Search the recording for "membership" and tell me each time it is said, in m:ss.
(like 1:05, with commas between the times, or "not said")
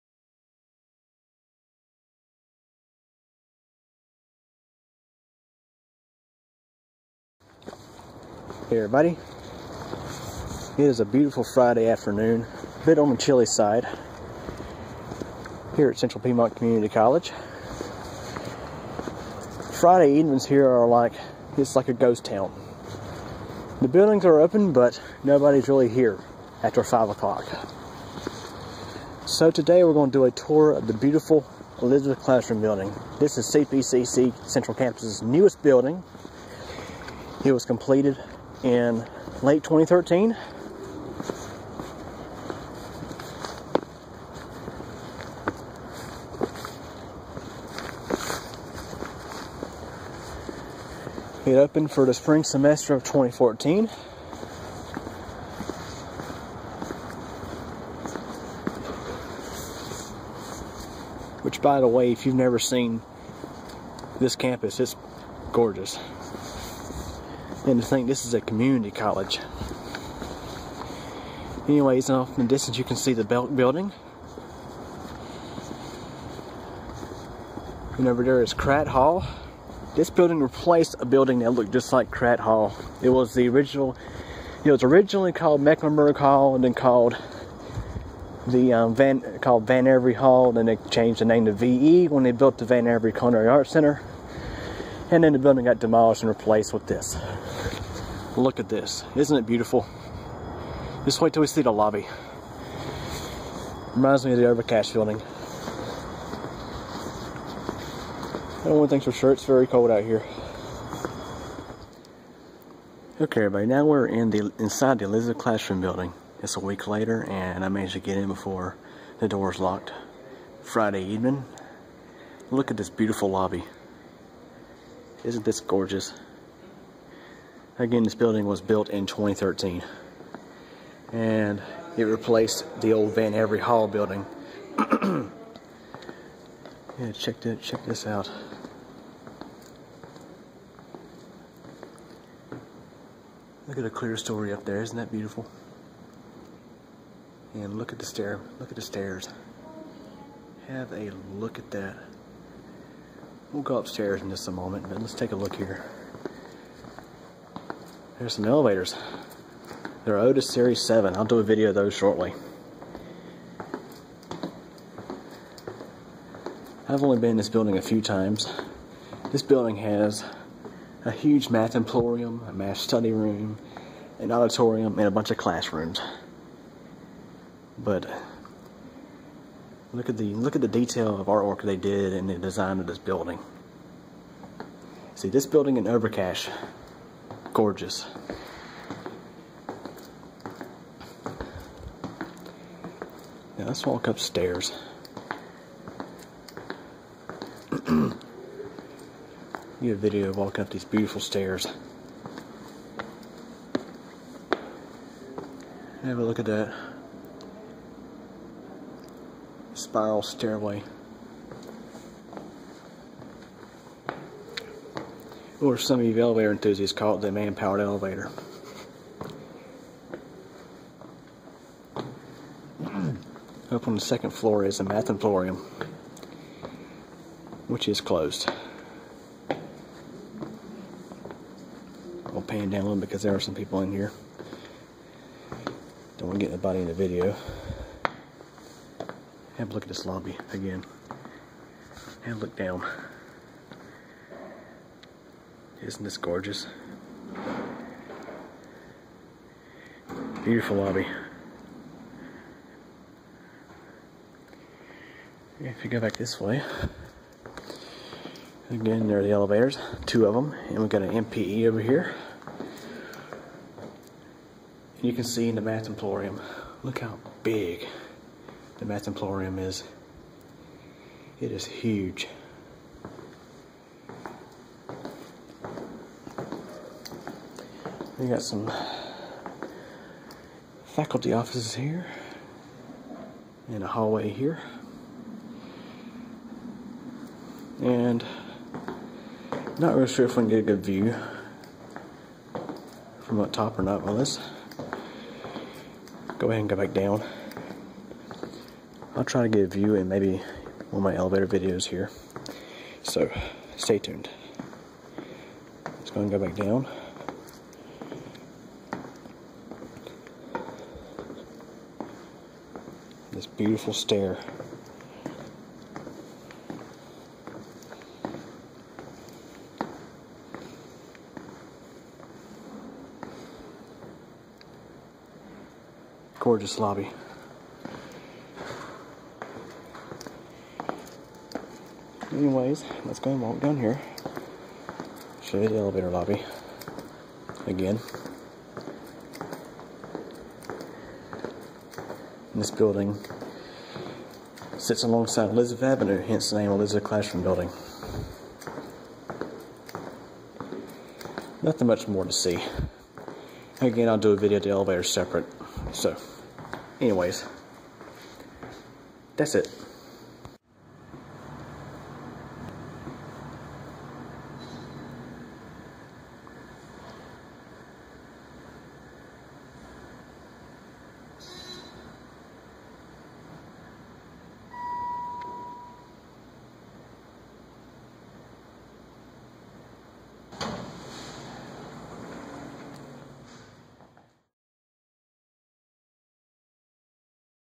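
not said.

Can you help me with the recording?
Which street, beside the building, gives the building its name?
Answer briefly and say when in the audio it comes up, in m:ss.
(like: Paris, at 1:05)
Elizabeth Avenue, at 5:45.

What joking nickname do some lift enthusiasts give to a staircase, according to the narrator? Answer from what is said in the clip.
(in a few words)
man-powered elevator.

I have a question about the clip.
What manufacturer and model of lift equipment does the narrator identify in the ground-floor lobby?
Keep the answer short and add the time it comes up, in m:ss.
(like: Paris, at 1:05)
Otis Series 7, at 2:40.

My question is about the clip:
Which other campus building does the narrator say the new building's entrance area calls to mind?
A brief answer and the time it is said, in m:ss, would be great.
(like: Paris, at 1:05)
Overcash building, at 1:44.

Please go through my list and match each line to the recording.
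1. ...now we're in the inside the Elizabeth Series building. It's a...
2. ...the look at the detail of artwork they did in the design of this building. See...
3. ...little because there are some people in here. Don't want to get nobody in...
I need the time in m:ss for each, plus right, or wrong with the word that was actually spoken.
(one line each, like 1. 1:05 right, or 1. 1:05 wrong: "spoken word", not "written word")
1. 1:53 wrong: "Classroom", not "Series"
2. 3:00 right
3. 3:52 wrong: "anybody", not "nobody".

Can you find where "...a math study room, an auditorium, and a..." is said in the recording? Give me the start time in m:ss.
2:52.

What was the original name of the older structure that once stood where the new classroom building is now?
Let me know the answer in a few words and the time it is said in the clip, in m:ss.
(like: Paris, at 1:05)
Mecklenburg Hall, at 1:25.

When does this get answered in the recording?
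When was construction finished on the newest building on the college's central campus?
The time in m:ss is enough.
0:39.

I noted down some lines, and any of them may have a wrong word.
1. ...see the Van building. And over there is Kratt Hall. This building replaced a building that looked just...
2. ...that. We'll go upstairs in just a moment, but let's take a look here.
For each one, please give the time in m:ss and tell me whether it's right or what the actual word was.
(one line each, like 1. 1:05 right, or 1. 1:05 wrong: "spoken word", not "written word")
1. 1:12 wrong: "Belk", not "Van"
2. 2:31 right.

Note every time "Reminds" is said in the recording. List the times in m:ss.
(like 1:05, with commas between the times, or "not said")
1:43.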